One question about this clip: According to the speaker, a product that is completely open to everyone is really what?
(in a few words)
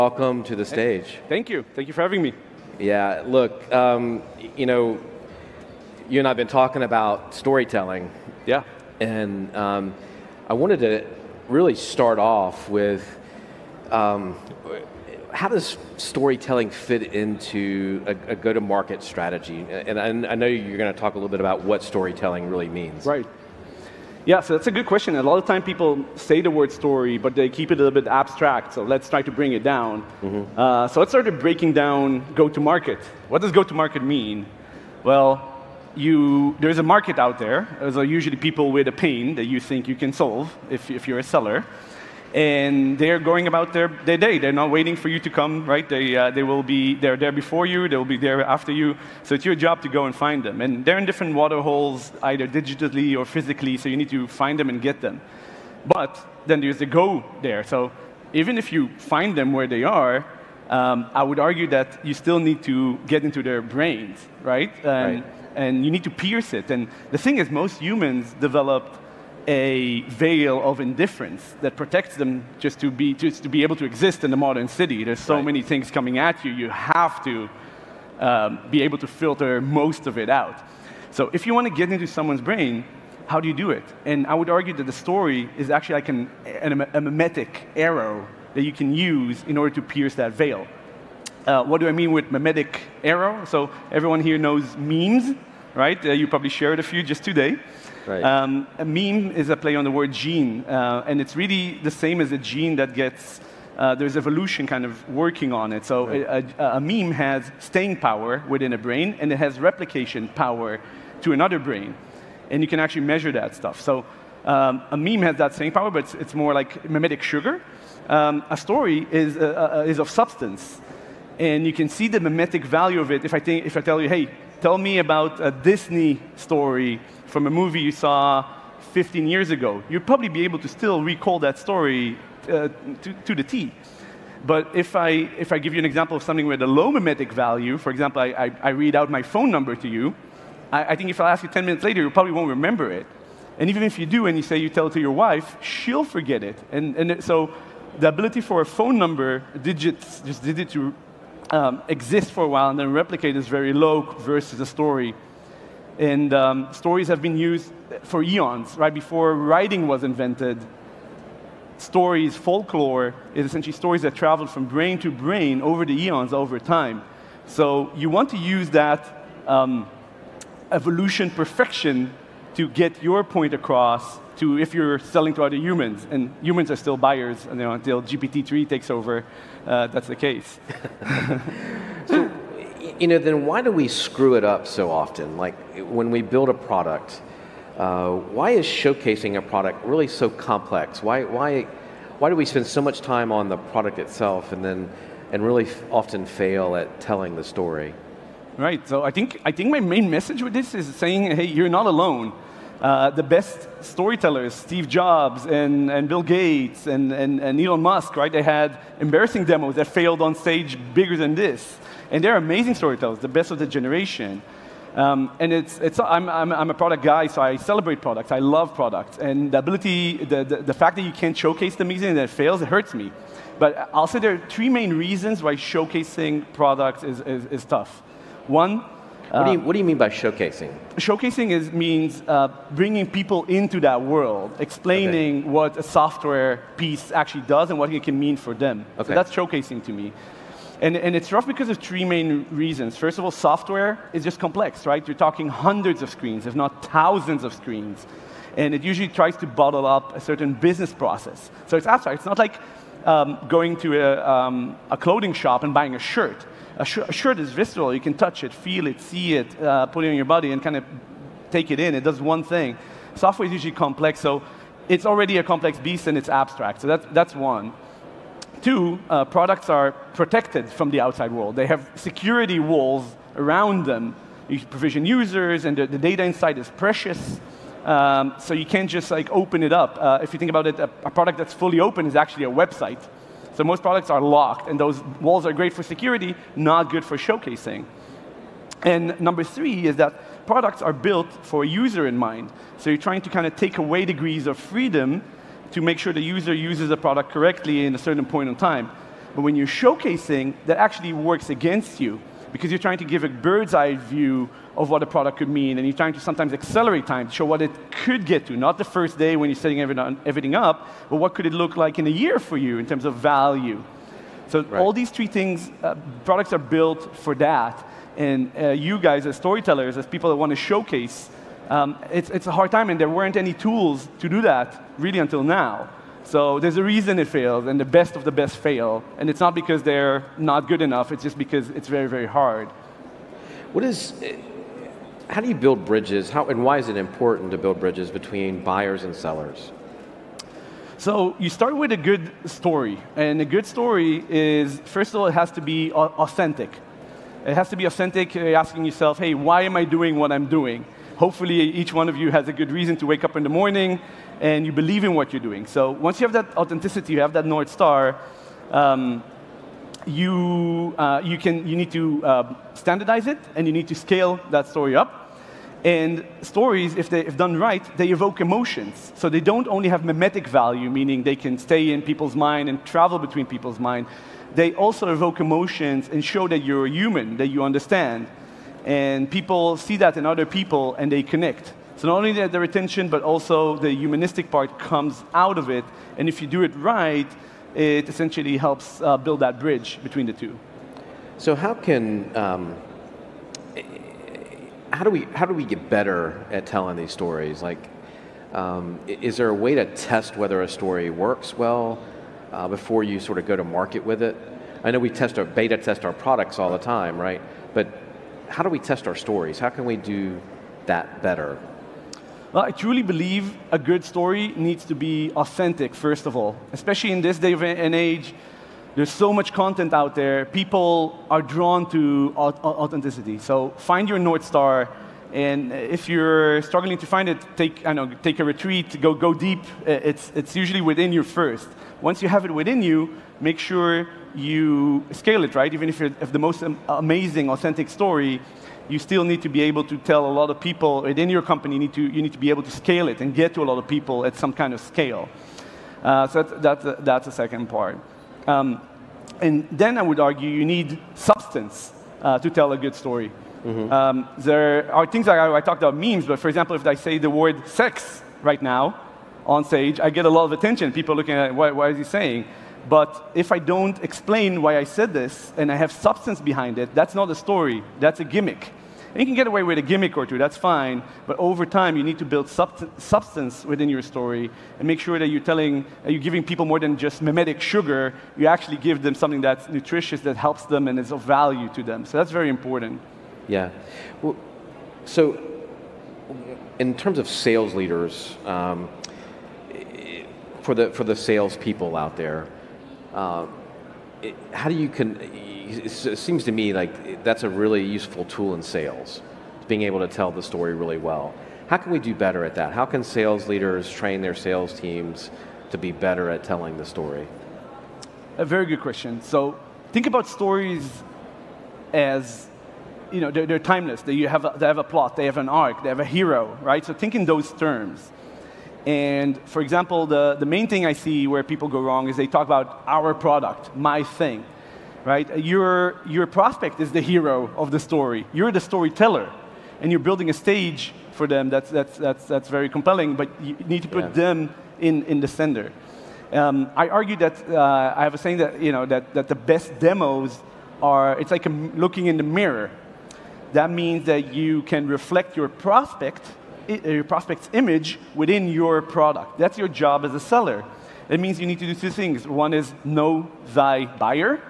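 a website.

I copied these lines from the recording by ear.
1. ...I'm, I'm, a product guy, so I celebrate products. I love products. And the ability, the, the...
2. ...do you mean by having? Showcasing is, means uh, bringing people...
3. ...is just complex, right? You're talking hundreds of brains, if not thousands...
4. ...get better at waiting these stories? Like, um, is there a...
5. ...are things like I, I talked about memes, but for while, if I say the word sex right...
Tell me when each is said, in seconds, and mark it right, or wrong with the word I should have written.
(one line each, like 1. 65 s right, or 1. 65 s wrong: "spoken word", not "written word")
1. 216 s right
2. 229 s wrong: "showcasing", not "having"
3. 244 s wrong: "screens", not "brains"
4. 395 s wrong: "telling", not "waiting"
5. 454 s wrong: "example", not "while".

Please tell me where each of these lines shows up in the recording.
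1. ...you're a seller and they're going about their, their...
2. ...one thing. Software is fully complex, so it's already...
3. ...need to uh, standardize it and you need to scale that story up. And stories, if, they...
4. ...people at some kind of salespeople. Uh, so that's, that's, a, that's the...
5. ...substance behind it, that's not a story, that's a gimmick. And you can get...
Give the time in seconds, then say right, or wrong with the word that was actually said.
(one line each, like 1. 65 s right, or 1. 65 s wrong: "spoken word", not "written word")
1. 41 s right
2. 262 s wrong: "usually", not "fully"
3. 361 s right
4. 443 s wrong: "scale", not "salespeople"
5. 465 s right.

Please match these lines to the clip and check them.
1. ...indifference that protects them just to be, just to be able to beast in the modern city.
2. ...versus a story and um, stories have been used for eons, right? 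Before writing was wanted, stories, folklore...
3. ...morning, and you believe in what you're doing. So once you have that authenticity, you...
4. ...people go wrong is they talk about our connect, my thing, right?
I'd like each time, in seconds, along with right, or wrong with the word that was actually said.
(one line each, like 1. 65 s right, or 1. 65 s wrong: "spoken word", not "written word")
1. 70 s wrong: "exist", not "beast"
2. 154 s wrong: "invented", not "wanted"
3. 353 s right
4. 521 s wrong: "product", not "connect".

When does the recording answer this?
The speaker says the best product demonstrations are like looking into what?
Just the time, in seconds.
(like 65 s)
542 s.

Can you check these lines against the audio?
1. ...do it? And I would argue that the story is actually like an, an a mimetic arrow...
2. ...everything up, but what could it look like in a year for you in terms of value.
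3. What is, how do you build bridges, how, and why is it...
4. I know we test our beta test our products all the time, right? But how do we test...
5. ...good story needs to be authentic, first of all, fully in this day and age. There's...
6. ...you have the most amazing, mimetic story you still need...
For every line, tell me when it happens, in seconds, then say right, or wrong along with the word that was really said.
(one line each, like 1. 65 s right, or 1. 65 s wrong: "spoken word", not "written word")
1. 83 s right
2. 309 s right
3. 333 s right
4. 404 s right
5. 413 s wrong: "especially", not "fully"
6. 435 s wrong: "authentic", not "mimetic".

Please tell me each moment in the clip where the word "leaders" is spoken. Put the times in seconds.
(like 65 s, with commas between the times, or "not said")
487 s, 503 s.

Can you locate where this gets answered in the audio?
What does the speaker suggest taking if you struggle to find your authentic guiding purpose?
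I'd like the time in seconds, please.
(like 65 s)
428 s.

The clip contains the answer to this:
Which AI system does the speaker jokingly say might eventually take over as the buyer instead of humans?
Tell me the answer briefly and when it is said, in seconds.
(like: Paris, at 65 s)
GPT-3, at 178 s.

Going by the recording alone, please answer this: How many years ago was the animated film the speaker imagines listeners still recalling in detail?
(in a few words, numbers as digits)
15.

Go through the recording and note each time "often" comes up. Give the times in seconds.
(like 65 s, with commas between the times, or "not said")
184 s, 195 s.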